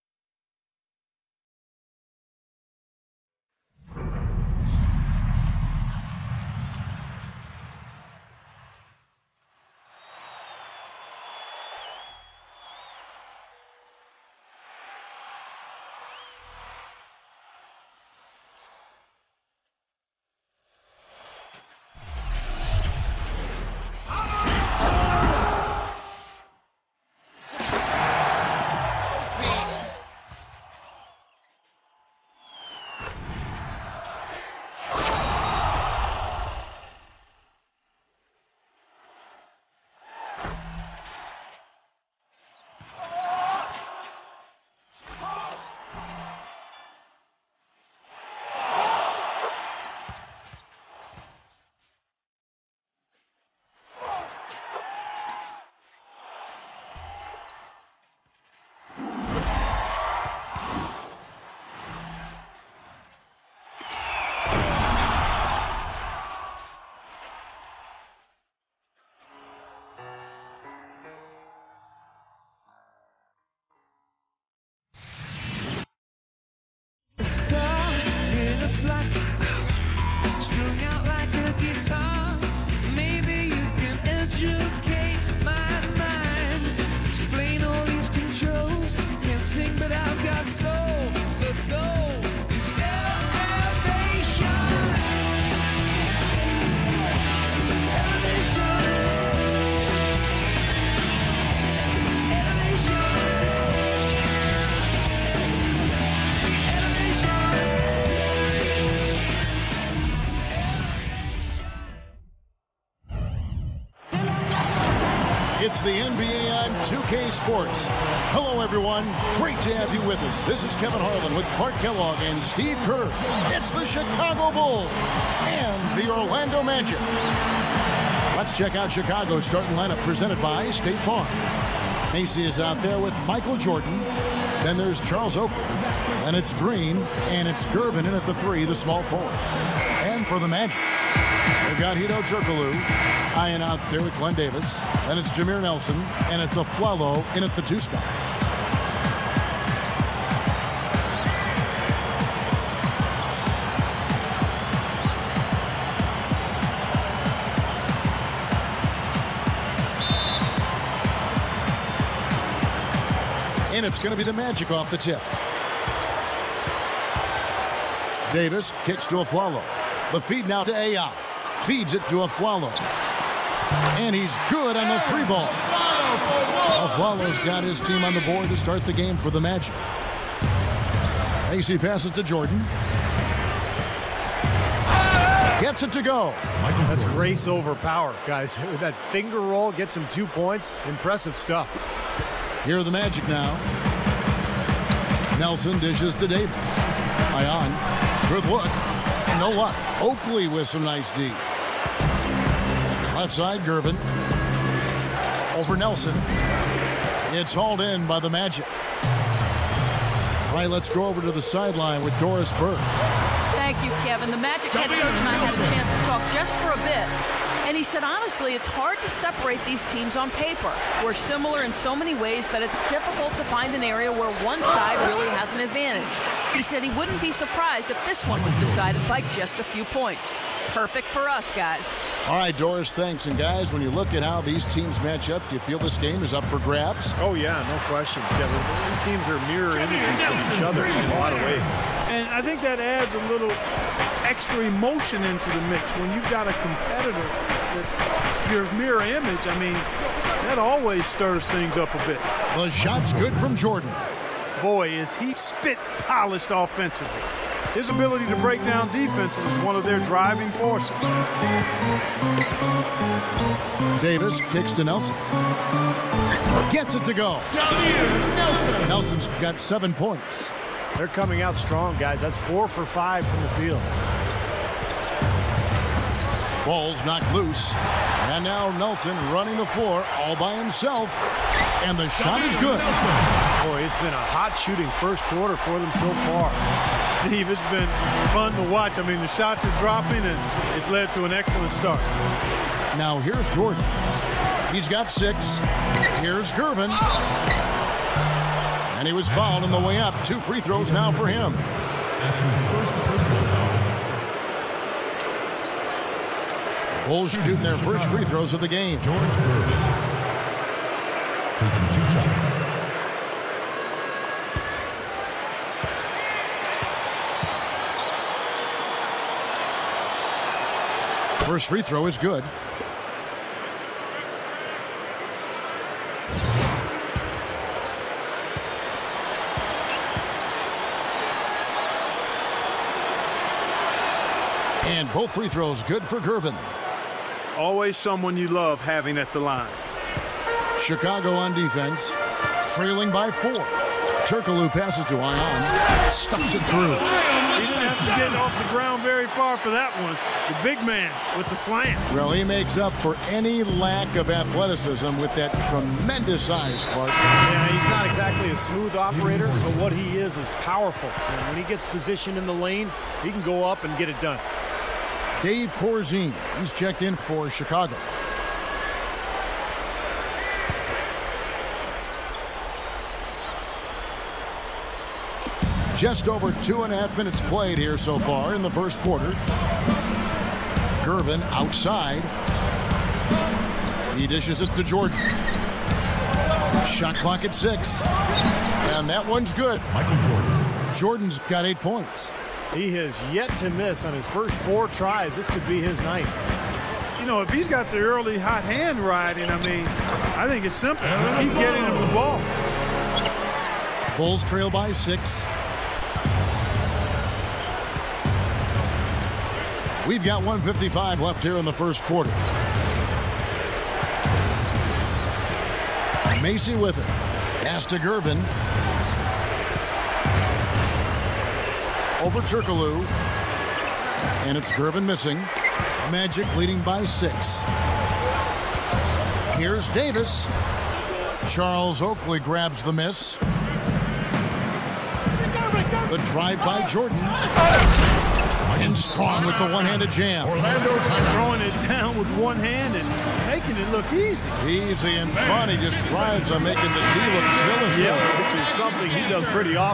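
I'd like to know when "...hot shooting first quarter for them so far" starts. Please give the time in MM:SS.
04:44.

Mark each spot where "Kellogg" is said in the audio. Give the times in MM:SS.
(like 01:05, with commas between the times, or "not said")
02:01.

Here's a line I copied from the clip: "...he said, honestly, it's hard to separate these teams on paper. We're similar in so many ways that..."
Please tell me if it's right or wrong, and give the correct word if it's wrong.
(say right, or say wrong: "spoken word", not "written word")
right.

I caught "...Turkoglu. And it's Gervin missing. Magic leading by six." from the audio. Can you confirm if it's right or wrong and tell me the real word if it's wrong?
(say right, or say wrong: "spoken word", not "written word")
right.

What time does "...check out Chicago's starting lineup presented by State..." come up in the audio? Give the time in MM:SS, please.
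02:08.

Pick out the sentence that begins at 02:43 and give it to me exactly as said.
And it's going to be the magic off the tip.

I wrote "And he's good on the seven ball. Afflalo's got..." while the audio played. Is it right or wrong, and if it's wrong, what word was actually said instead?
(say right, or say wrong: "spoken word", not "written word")
wrong: "three", not "seven".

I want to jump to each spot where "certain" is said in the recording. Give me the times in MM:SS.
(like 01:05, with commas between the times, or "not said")
not said.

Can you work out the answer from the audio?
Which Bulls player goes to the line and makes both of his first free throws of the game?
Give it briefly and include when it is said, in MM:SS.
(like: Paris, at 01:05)
George Gervin, at 05:09.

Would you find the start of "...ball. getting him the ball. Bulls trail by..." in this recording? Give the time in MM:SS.
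06:41.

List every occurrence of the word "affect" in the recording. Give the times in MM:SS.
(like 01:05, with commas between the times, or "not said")
not said.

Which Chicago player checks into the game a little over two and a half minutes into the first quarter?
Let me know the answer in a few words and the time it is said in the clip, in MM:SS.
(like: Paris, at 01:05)
Dave Corzine, at 06:05.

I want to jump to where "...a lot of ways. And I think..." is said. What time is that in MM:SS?
04:01.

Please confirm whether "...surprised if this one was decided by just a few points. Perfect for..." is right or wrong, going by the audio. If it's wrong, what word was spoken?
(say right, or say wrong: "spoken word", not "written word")
right.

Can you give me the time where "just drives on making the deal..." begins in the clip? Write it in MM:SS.
07:25.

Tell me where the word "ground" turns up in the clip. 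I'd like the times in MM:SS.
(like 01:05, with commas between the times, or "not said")
05:48.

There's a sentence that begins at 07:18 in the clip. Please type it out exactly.
And strong with the one-handed jam.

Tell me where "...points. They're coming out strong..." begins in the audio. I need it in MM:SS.
04:29.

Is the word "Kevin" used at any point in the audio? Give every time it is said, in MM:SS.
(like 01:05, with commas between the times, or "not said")
02:00, 03:34.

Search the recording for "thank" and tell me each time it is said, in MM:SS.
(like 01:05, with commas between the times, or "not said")
03:33, 03:52.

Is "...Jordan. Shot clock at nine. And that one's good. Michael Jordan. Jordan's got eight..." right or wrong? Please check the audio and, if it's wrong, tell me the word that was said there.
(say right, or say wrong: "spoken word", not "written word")
wrong: "six", not "nine".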